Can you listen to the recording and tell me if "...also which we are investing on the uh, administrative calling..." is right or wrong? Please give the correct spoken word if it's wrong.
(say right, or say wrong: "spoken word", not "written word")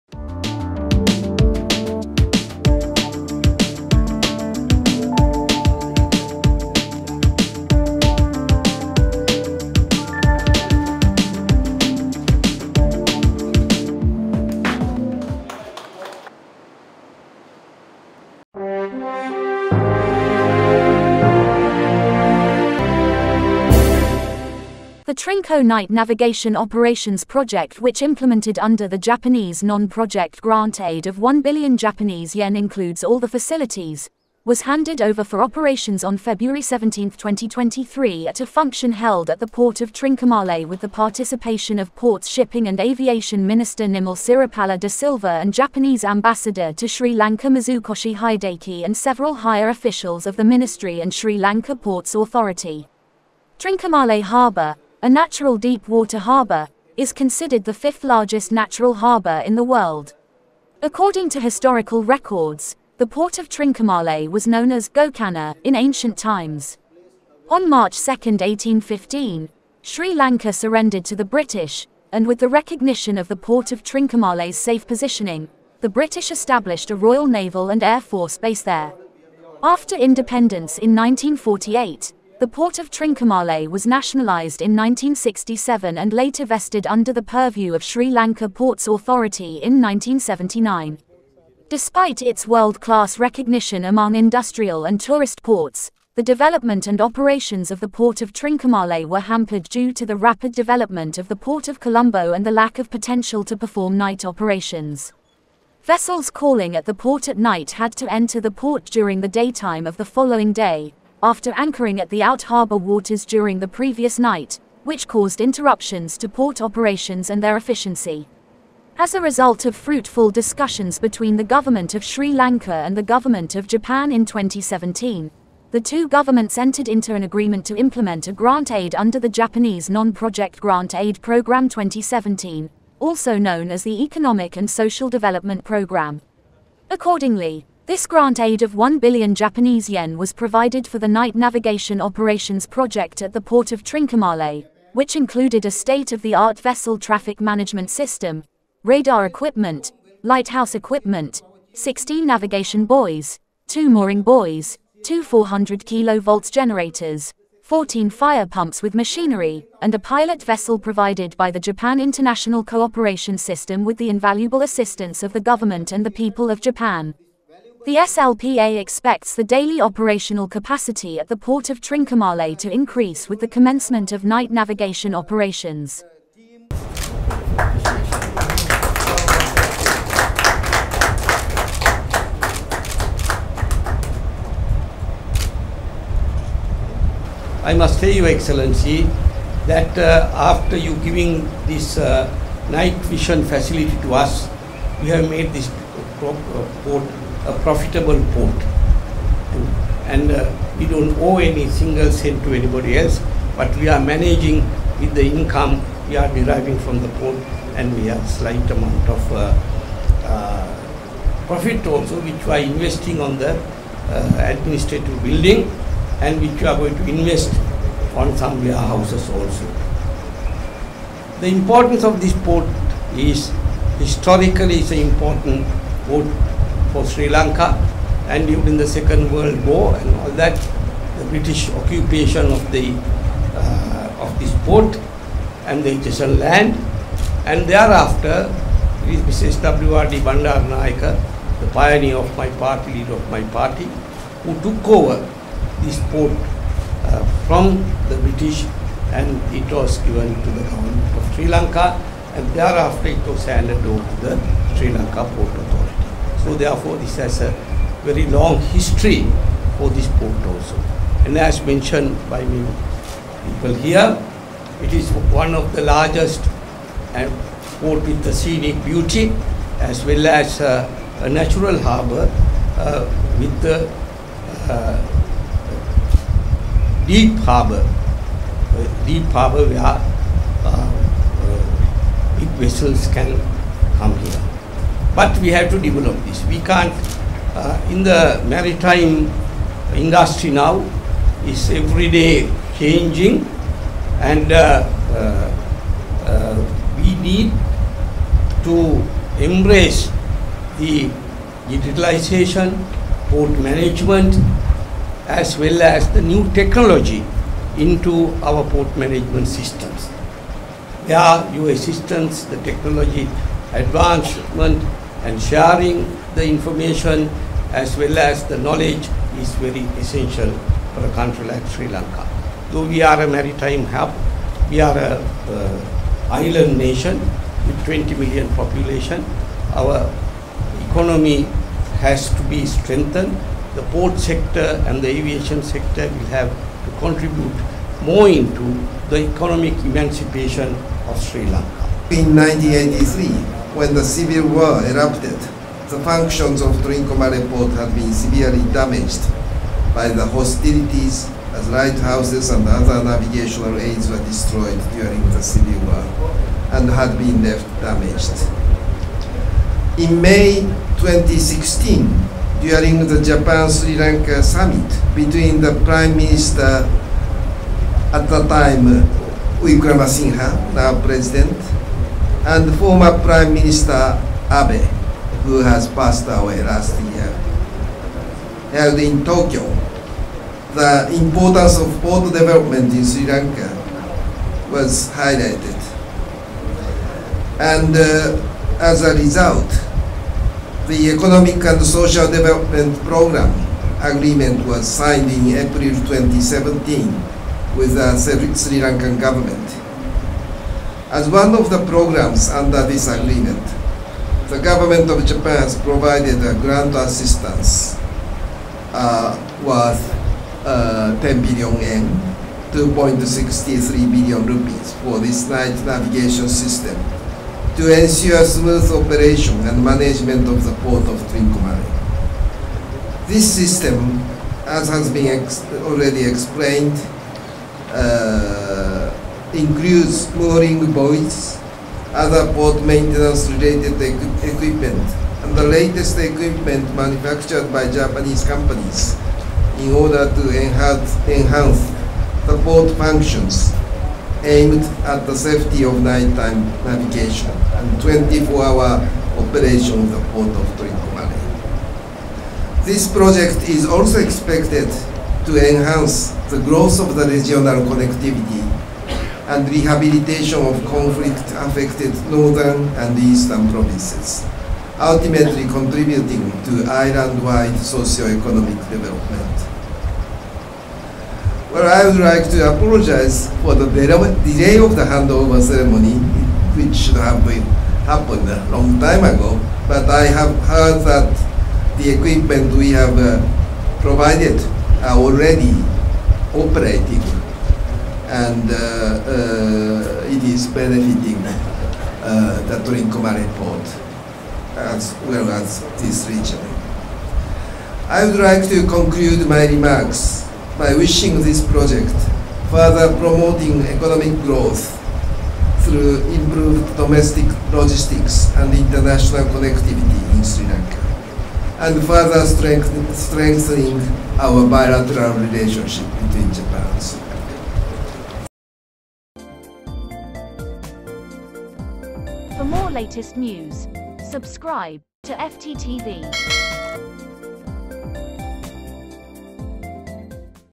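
wrong: "building", not "calling".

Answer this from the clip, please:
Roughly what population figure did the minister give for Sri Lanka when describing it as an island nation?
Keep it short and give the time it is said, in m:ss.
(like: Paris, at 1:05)
20 million, at 5:27.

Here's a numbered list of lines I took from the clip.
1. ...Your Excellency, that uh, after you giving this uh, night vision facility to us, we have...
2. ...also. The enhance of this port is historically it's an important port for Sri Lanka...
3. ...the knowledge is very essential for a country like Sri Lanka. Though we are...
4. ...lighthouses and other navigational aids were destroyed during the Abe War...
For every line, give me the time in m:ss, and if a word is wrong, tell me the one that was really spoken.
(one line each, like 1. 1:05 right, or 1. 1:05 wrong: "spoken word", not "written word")
1. 3:08 right
2. 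3:39 wrong: "importance", not "enhance"
3. 5:18 right
4. 5:51 wrong: "Civil", not "Abe".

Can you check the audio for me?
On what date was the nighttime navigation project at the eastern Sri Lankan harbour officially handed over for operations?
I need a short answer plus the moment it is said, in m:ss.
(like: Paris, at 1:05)
February 17, 2023, at 0:36.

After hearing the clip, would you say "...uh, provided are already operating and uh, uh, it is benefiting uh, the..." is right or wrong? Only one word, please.
right.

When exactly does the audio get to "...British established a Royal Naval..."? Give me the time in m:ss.
1:15.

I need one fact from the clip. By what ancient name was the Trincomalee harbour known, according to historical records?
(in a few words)
Gokana.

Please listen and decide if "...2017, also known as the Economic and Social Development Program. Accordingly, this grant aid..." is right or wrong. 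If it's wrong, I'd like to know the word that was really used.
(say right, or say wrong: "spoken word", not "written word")
right.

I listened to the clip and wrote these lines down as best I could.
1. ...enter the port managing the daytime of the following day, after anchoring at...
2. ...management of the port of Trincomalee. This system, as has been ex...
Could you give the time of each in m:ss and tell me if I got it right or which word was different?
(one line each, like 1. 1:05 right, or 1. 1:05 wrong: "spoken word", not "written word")
1. 1:48 wrong: "during", not "managing"
2. 6:59 right.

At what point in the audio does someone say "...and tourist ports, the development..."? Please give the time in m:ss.
1:34.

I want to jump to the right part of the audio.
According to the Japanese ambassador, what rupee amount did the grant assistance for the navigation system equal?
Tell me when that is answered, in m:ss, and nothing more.
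6:52.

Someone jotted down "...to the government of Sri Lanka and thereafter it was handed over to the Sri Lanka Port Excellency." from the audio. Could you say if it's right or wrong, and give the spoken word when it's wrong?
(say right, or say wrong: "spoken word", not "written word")
wrong: "Authority", not "Excellency".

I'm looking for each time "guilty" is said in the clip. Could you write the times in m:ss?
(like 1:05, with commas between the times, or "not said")
not said.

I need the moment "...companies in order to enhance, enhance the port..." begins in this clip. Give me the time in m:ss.
7:18.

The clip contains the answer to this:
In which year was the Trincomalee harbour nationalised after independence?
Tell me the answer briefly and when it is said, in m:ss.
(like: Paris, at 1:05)
1967, at 1:24.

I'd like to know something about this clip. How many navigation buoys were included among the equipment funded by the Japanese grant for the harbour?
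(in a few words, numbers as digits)
16.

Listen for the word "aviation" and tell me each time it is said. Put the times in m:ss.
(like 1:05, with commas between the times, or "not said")
0:42, 5:35.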